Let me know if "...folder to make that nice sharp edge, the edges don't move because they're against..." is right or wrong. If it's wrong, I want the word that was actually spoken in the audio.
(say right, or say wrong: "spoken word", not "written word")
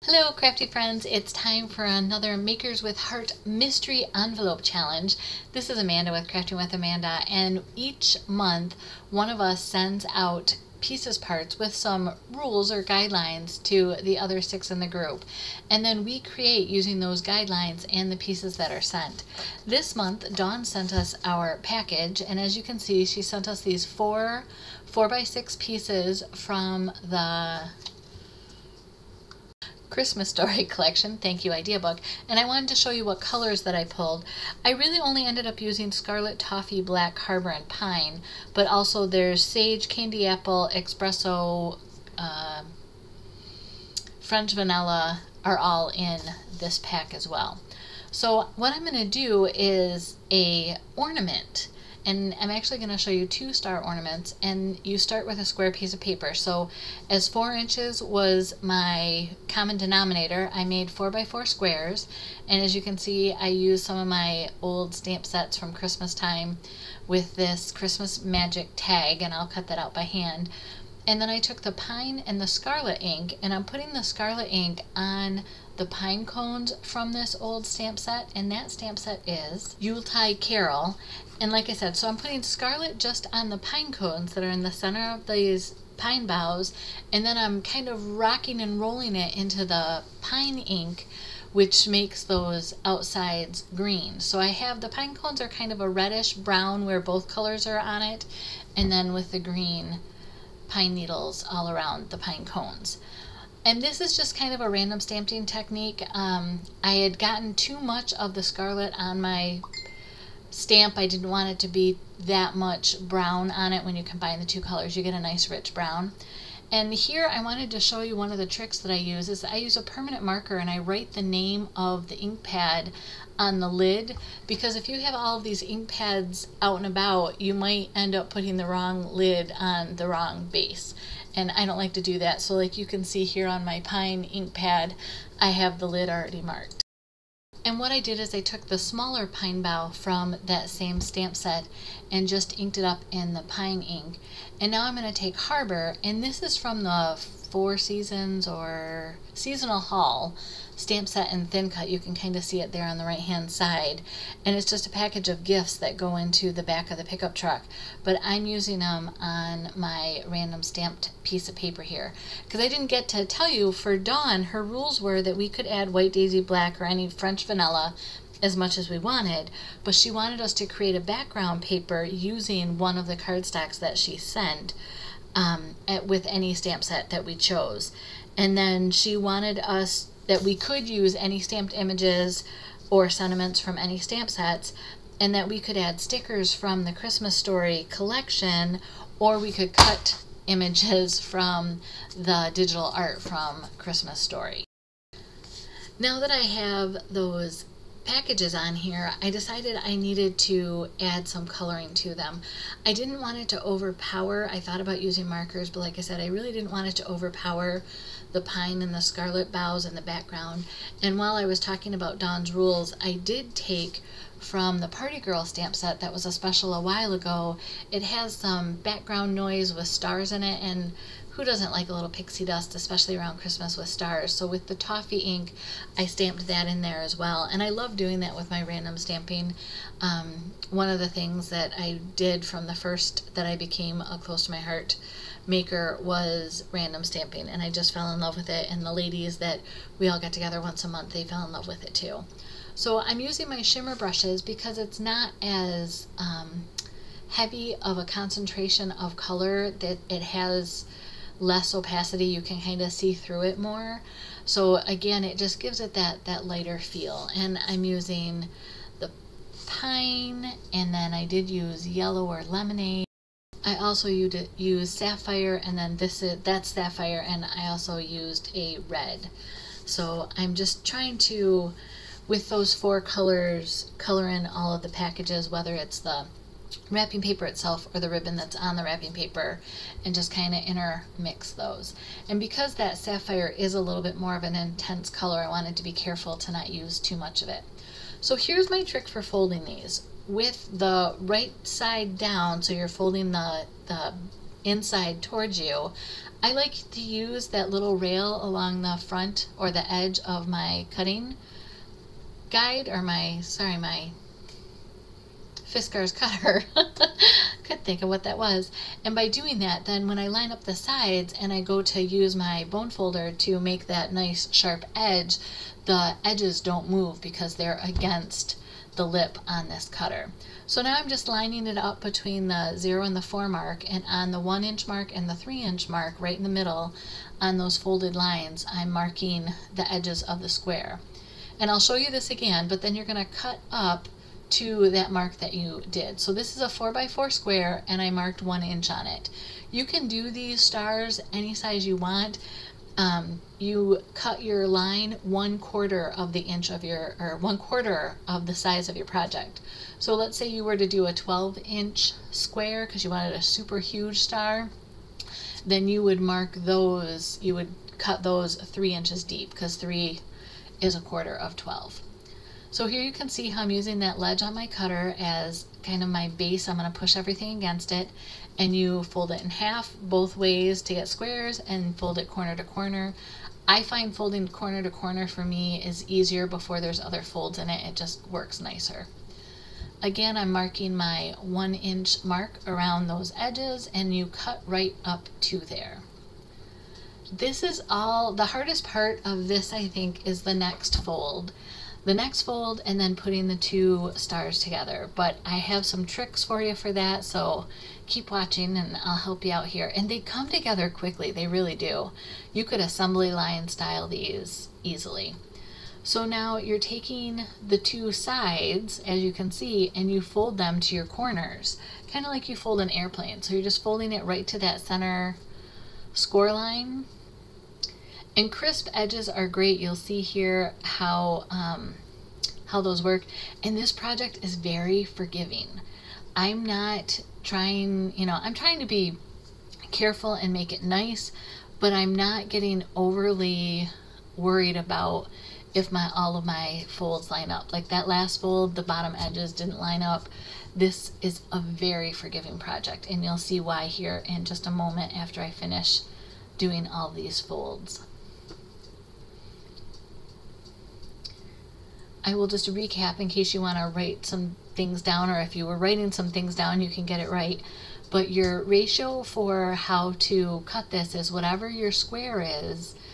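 right.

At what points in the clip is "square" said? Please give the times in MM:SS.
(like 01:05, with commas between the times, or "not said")
00:55, 01:01, 05:30, 05:37, 05:52, 06:11, 07:41.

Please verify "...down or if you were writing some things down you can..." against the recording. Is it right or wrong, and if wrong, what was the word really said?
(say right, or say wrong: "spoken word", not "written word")
right.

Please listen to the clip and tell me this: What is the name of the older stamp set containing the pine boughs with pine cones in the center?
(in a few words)
Yuletide Carol.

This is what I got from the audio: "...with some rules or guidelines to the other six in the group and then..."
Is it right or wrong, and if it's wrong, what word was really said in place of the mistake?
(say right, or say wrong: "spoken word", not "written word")
right.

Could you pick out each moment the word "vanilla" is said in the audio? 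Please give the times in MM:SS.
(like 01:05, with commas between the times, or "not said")
00:44, 02:47.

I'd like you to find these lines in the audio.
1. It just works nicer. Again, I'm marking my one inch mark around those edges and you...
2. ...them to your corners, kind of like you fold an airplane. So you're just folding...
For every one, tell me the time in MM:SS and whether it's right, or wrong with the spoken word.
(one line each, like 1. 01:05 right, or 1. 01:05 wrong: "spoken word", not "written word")
1. 06:17 right
2. 06:50 right.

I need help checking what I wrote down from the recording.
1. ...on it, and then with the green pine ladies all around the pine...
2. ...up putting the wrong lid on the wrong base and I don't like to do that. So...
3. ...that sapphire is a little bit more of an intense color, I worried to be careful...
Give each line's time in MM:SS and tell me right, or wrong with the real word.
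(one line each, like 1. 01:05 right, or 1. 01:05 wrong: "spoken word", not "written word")
1. 01:37 wrong: "needles", not "ladies"
2. 02:08 right
3. 04:42 wrong: "wanted", not "worried".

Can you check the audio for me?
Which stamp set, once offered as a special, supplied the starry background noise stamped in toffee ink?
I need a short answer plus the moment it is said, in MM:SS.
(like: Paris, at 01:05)
Party Girl, at 03:34.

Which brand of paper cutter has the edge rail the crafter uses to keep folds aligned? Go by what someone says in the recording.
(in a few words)
Fiskars.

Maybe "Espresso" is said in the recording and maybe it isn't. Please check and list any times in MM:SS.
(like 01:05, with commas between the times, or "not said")
00:40.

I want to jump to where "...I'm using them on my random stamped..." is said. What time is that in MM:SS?
02:38.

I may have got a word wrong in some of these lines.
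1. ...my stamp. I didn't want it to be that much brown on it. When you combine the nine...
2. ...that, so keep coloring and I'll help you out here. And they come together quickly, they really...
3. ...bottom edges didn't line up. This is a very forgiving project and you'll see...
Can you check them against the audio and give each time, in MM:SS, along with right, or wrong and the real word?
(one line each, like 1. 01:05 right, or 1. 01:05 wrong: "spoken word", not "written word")
1. 01:49 wrong: "two", not "nine"
2. 06:36 wrong: "watching", not "coloring"
3. 07:18 right.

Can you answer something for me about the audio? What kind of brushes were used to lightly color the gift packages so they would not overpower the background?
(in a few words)
Shimmer brushes.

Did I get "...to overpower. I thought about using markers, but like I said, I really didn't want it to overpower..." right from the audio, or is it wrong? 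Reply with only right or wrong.
right.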